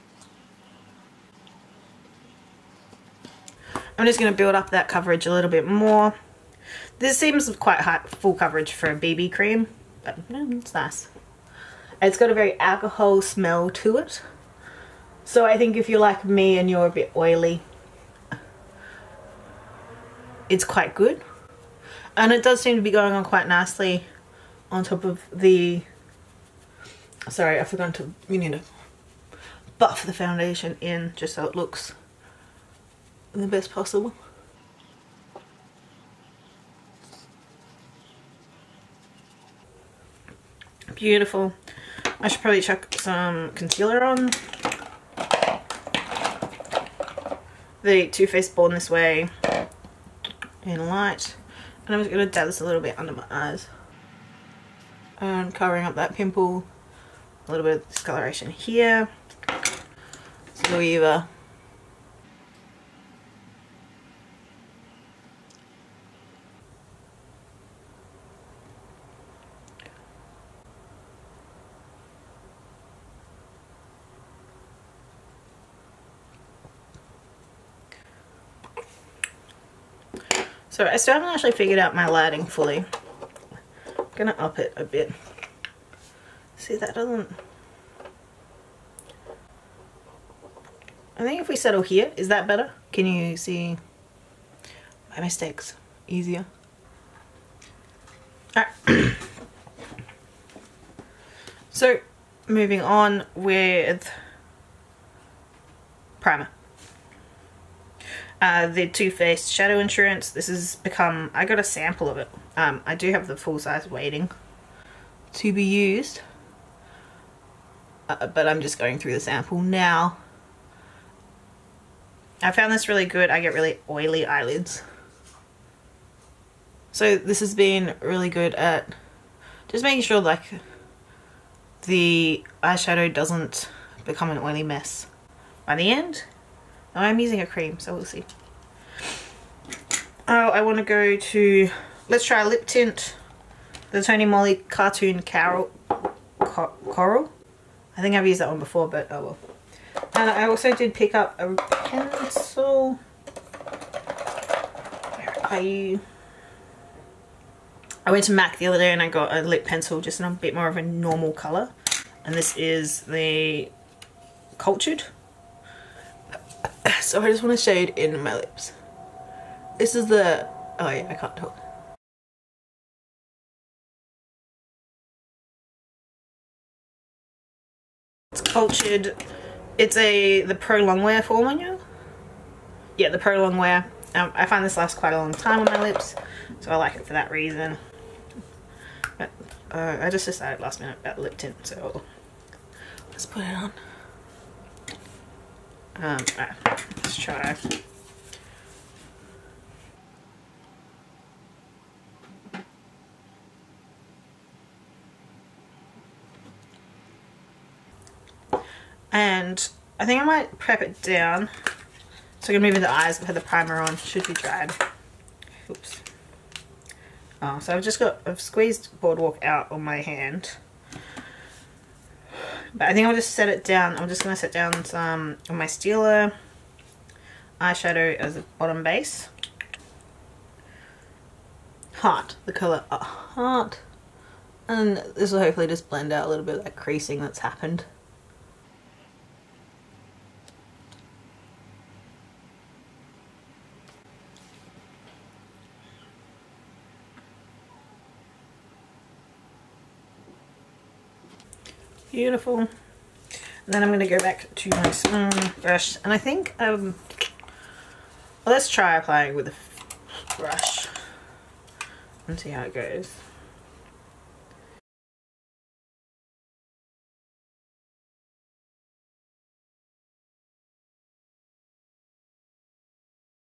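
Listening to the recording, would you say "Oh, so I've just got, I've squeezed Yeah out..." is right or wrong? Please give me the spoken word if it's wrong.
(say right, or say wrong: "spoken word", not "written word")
wrong: "Boardwalk", not "Yeah".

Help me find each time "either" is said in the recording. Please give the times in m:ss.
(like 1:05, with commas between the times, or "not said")
1:00.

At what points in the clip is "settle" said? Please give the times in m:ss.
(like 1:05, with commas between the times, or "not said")
1:31.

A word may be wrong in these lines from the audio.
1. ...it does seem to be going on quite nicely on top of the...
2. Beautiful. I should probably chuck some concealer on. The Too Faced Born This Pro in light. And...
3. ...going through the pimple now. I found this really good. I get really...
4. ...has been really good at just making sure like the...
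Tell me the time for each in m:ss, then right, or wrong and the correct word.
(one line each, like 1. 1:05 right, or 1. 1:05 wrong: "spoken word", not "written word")
1. 0:22 right
2. 0:40 wrong: "Way", not "Pro"
3. 1:58 wrong: "sample", not "pimple"
4. 2:07 right.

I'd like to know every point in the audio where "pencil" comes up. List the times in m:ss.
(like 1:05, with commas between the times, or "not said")
2:31, 2:39.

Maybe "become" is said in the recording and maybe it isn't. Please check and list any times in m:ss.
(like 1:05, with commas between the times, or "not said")
1:50, 2:14.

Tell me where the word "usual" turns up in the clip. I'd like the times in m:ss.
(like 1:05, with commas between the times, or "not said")
not said.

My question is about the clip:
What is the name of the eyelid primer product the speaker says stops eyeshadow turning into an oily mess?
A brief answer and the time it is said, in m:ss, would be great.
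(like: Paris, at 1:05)
Too Faced Shadow Insurance, at 1:48.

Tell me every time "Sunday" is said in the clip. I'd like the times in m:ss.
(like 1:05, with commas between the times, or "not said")
not said.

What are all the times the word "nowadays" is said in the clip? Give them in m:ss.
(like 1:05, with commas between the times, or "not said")
not said.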